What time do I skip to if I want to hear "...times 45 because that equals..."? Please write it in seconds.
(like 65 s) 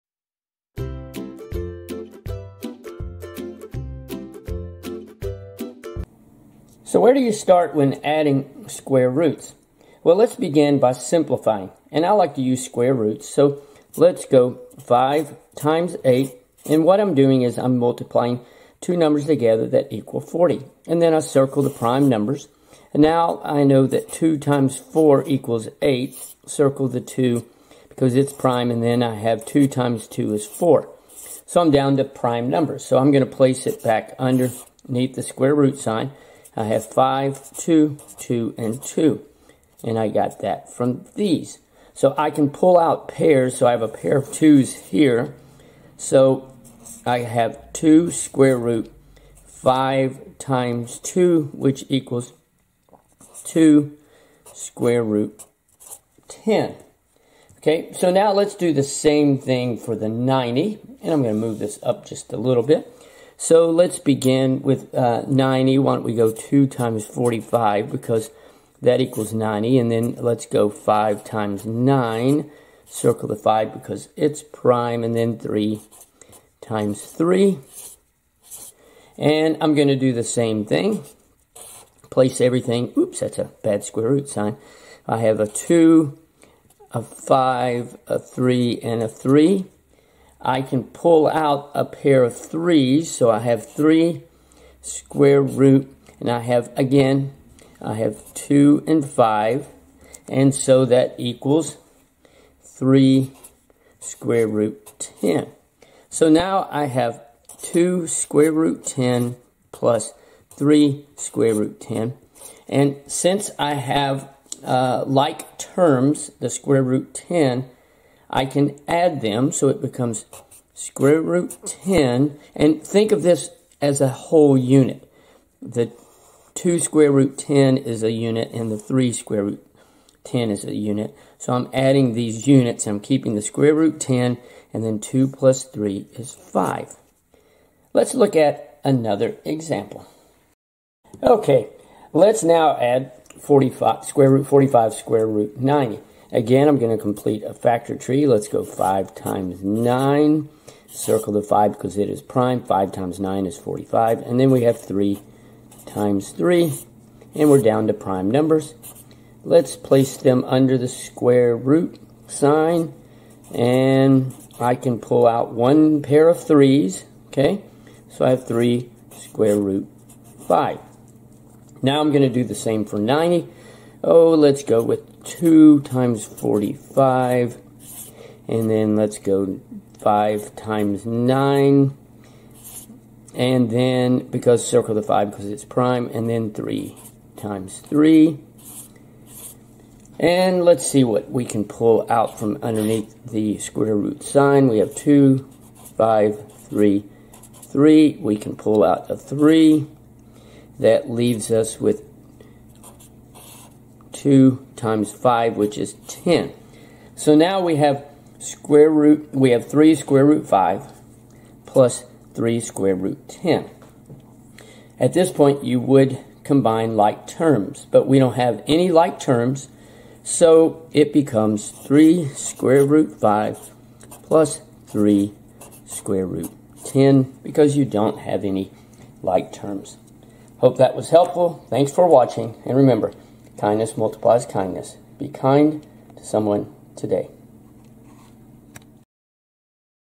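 66 s.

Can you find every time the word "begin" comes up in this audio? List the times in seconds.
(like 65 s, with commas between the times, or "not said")
10 s, 63 s.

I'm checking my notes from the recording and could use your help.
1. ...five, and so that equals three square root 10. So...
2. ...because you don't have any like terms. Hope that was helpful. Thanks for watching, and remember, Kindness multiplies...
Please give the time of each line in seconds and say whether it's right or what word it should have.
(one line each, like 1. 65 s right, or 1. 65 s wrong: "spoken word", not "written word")
1. 99 s right
2. 227 s right.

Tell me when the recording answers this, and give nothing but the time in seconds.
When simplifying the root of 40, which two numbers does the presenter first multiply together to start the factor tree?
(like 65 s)
14 s.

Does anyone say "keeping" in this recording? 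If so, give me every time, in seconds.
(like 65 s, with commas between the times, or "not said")
133 s.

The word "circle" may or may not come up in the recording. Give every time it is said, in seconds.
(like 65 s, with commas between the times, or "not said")
21 s, 26 s, 72 s, 150 s, 184 s.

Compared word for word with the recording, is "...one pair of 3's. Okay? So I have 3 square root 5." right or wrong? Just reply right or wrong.
right.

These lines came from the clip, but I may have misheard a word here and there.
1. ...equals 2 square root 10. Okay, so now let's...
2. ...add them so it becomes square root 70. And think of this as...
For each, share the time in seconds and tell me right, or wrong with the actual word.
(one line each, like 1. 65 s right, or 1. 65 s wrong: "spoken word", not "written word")
1. 51 s right
2. 118 s wrong: "10", not "70".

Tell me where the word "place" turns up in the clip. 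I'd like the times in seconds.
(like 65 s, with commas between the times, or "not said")
33 s, 82 s, 159 s.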